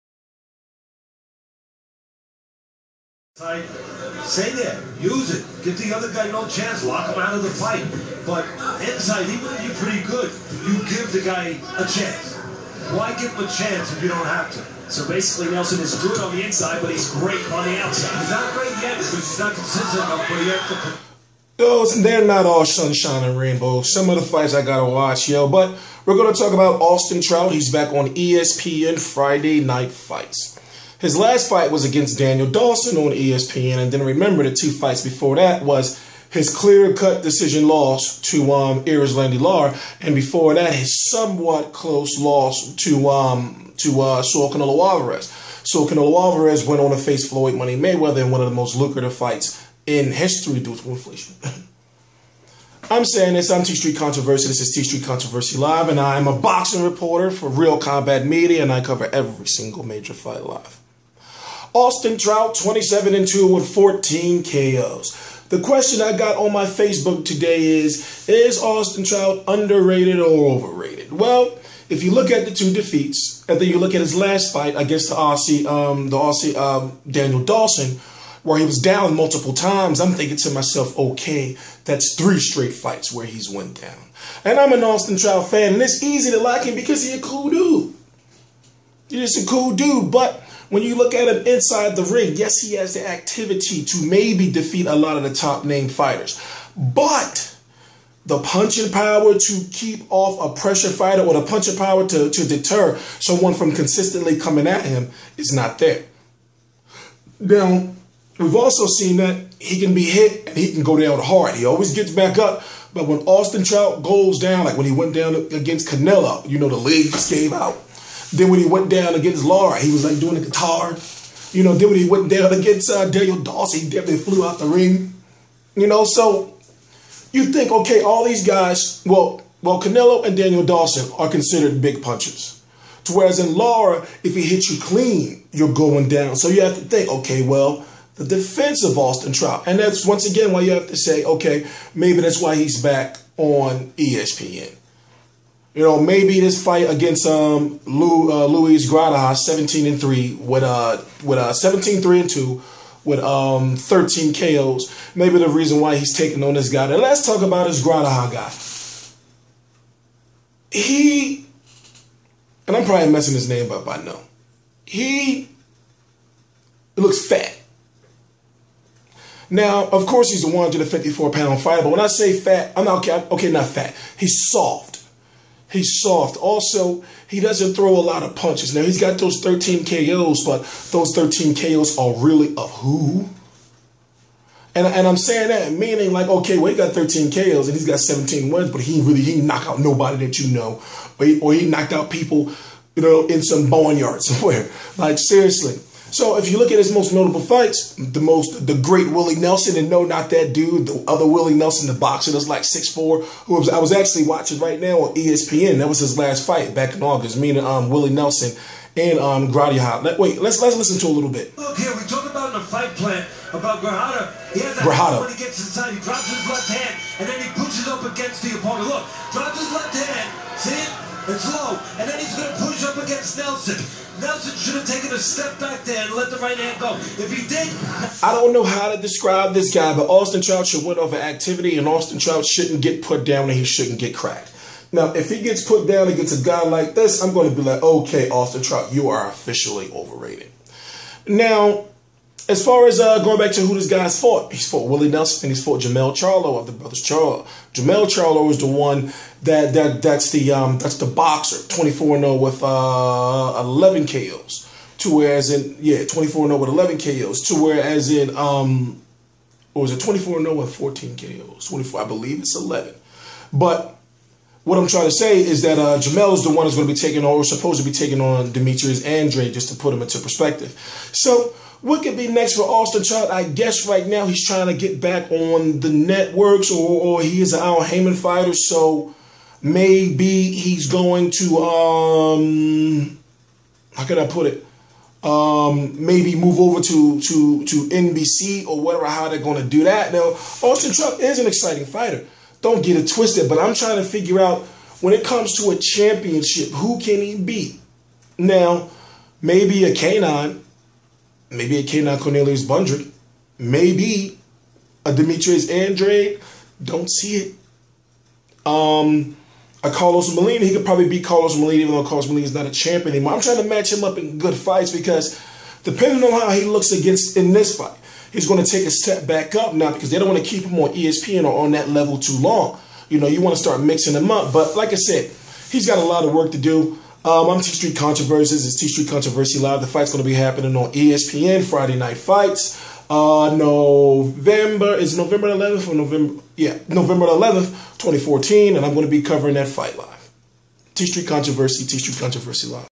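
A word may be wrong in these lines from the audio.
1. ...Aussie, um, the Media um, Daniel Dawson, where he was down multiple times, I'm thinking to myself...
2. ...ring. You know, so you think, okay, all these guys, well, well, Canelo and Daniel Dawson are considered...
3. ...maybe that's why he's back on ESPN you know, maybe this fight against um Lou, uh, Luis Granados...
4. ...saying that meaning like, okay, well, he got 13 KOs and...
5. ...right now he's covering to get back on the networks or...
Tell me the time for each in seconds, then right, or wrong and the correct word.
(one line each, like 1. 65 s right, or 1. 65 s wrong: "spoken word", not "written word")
1. 75 s wrong: "Aussie", not "Media"
2. 124 s right
3. 141 s right
4. 185 s right
5. 273 s wrong: "trying", not "covering".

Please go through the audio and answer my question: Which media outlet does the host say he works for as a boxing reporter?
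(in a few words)
Real Combat Media.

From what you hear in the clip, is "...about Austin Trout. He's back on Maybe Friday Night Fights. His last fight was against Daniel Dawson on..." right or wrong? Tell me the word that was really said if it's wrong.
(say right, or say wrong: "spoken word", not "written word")
wrong: "ESPN", not "Maybe".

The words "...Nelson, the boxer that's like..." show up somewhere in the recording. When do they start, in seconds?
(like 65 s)
201 s.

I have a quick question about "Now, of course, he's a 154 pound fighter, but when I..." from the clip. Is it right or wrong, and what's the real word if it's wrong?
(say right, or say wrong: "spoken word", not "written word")
right.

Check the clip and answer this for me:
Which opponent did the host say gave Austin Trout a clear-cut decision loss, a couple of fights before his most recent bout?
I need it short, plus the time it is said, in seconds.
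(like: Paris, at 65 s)
Erislandy Lara, at 38 s.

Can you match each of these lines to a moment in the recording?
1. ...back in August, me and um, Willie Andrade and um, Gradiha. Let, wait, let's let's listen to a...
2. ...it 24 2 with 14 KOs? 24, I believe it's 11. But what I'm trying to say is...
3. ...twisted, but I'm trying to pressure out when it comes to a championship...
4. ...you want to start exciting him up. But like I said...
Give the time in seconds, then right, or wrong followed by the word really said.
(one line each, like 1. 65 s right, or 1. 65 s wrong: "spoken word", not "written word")
1. 206 s wrong: "Nelson", not "Andrade"
2. 259 s wrong: "0", not "2"
3. 293 s wrong: "figure", not "pressure"
4. 323 s wrong: "mixing", not "exciting".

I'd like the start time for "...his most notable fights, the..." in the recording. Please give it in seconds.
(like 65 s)
196 s.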